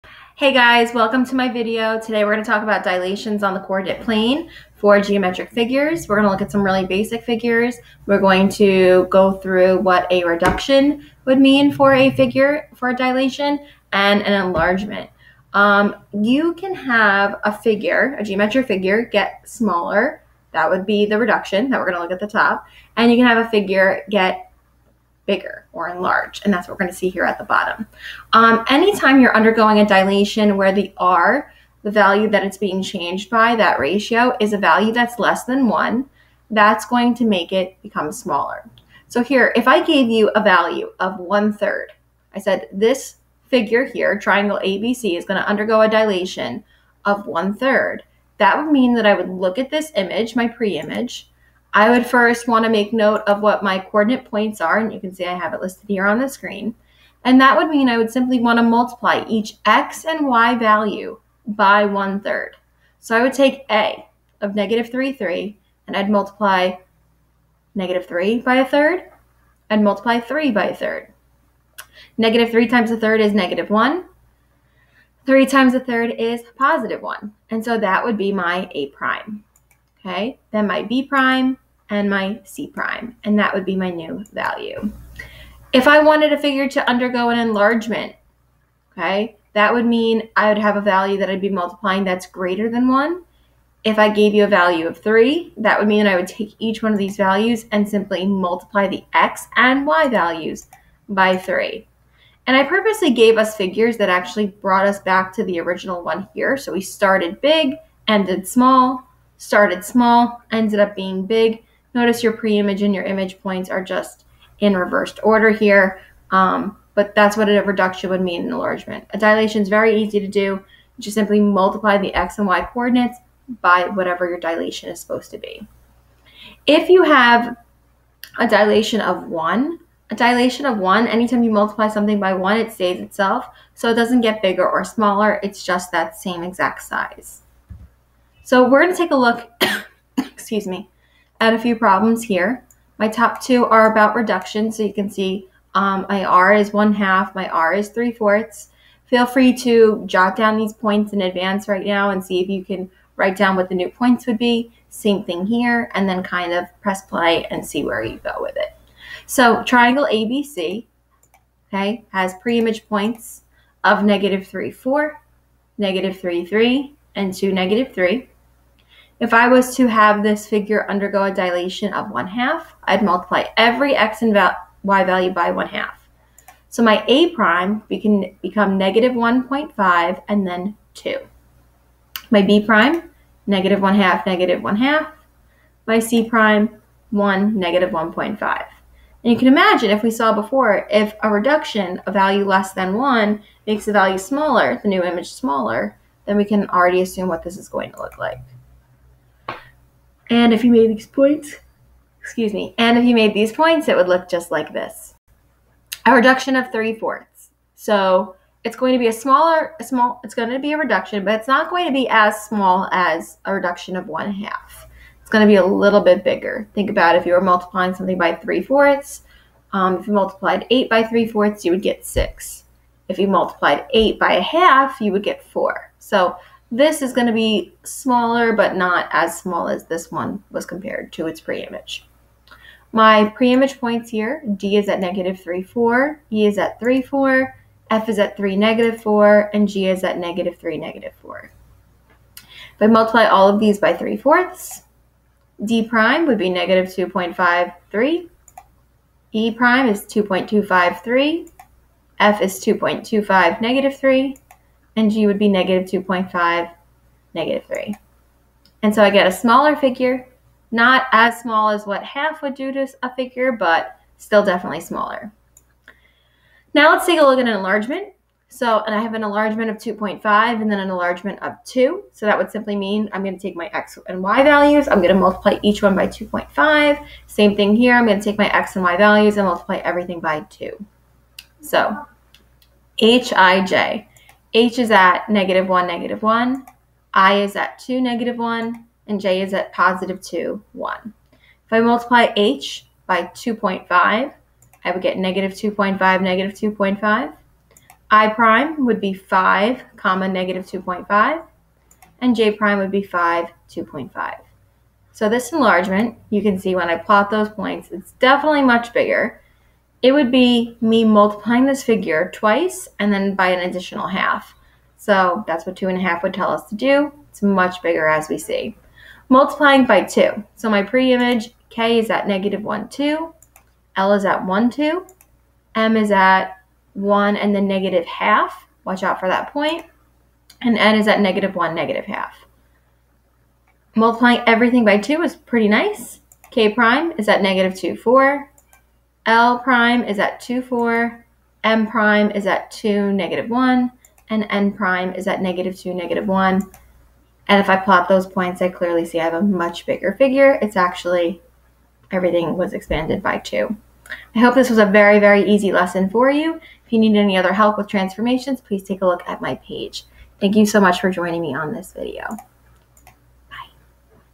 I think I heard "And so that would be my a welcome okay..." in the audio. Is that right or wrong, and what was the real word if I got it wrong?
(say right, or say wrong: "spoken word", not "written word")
wrong: "prime", not "welcome".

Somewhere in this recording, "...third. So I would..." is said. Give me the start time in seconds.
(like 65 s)
62 s.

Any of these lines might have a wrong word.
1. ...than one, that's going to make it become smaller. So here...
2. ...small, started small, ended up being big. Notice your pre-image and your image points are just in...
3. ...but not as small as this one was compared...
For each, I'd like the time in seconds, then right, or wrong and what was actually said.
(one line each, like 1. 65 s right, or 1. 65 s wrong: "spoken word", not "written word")
1. 35 s right
2. 108 s right
3. 228 s right.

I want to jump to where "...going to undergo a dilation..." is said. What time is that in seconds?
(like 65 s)
45 s.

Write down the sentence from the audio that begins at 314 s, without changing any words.
So that's what two and a half would tell us to do.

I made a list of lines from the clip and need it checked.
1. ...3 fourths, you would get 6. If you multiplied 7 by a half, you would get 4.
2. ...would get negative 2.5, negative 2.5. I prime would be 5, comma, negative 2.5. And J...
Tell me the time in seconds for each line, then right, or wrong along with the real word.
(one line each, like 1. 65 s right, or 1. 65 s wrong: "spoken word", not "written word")
1. 221 s wrong: "8", not "7"
2. 294 s right.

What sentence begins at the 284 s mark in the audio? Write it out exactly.
H is at negative 1, negative 1.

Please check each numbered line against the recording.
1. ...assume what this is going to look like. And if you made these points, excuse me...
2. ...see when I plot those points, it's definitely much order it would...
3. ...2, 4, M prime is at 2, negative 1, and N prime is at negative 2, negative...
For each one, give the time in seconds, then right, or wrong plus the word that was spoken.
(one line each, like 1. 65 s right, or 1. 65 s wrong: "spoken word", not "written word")
1. 197 s right
2. 306 s wrong: "bigger", not "order"
3. 340 s right.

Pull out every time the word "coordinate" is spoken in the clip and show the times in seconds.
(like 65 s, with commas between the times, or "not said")
3 s, 53 s, 122 s.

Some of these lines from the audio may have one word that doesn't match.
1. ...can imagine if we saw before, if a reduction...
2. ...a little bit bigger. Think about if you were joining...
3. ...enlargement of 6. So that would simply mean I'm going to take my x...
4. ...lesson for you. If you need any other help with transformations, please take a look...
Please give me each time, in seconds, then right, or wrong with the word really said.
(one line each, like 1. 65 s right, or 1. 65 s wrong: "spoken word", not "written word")
1. 189 s right
2. 215 s wrong: "multiplying", not "joining"
3. 270 s wrong: "2", not "6"
4. 355 s right.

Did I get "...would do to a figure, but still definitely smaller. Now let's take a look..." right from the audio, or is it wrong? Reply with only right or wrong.
right.